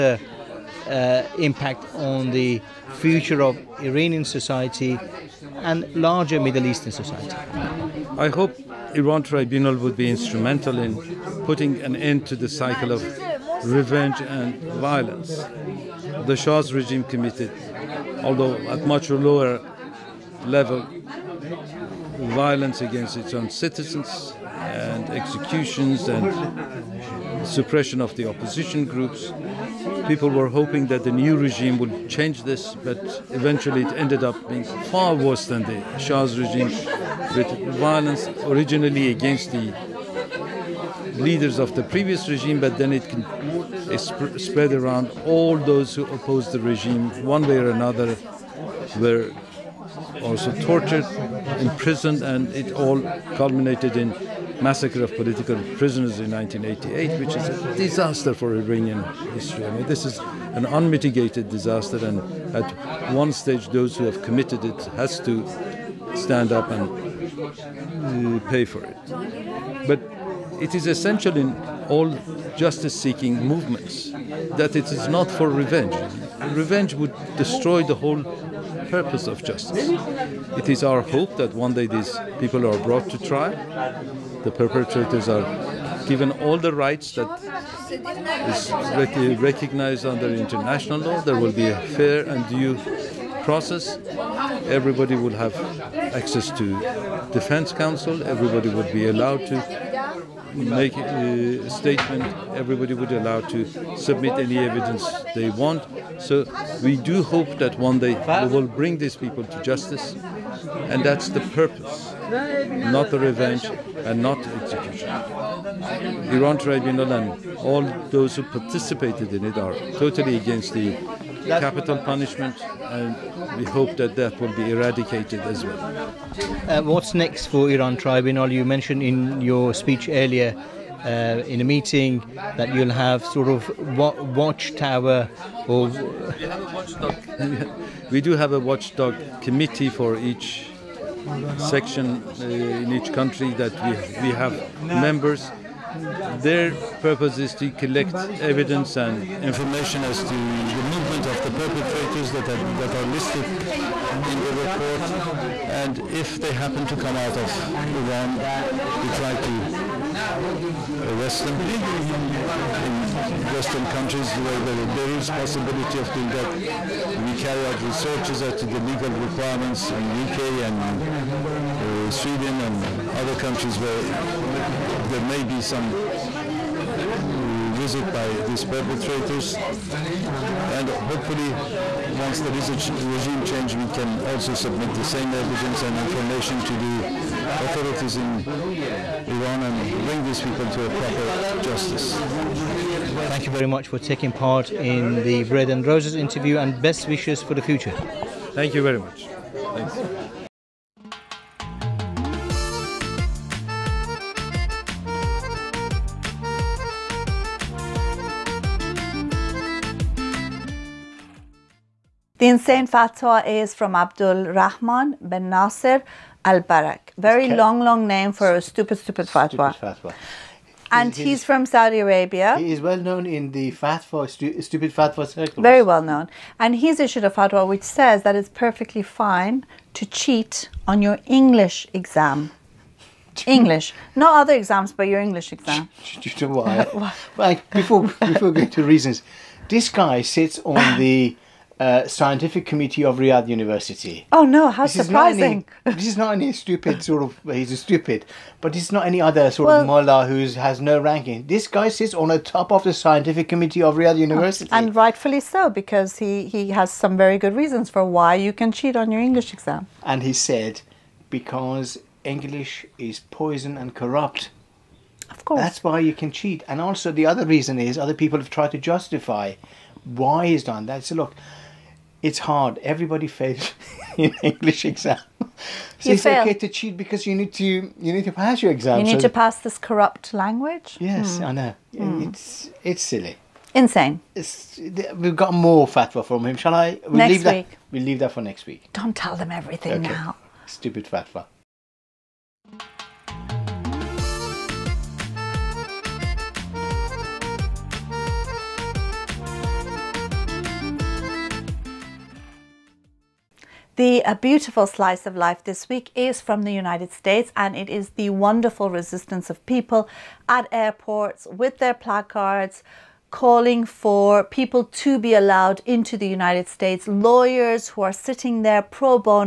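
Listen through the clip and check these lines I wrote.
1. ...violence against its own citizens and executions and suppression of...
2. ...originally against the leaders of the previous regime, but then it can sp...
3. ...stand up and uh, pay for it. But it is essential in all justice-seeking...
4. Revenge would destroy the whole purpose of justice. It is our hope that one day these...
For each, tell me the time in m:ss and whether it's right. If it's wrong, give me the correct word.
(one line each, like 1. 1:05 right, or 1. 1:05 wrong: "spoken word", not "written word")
1. 0:22 right
2. 0:38 right
3. 1:06 right
4. 1:16 right.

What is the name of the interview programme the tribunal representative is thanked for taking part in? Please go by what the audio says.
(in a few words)
Bread and Roses.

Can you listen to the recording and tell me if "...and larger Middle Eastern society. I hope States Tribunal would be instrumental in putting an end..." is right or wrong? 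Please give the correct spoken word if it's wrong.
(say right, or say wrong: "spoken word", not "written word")
wrong: "Iran", not "States".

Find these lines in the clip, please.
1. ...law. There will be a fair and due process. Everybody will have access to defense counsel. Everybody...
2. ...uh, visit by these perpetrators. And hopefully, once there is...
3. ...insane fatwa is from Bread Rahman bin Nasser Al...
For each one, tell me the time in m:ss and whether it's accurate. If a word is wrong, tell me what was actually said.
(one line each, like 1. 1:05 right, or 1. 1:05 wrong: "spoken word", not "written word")
1. 1:30 right
2. 2:55 right
3. 3:32 wrong: "Abdul", not "Bread".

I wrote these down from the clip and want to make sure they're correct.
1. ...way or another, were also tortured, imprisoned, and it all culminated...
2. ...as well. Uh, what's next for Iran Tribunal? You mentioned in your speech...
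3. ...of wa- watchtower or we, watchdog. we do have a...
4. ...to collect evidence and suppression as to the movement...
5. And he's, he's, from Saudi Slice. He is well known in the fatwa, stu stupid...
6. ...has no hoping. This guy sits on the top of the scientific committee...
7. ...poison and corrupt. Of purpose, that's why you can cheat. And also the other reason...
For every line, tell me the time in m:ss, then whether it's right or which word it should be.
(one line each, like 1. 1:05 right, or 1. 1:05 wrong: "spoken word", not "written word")
1. 0:47 right
2. 2:05 right
3. 2:13 right
4. 2:27 wrong: "information", not "suppression"
5. 3:40 wrong: "Arabia", not "Slice"
6. 4:10 wrong: "ranking", not "hoping"
7. 4:23 wrong: "course", not "purpose".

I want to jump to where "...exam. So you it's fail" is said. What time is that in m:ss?
4:34.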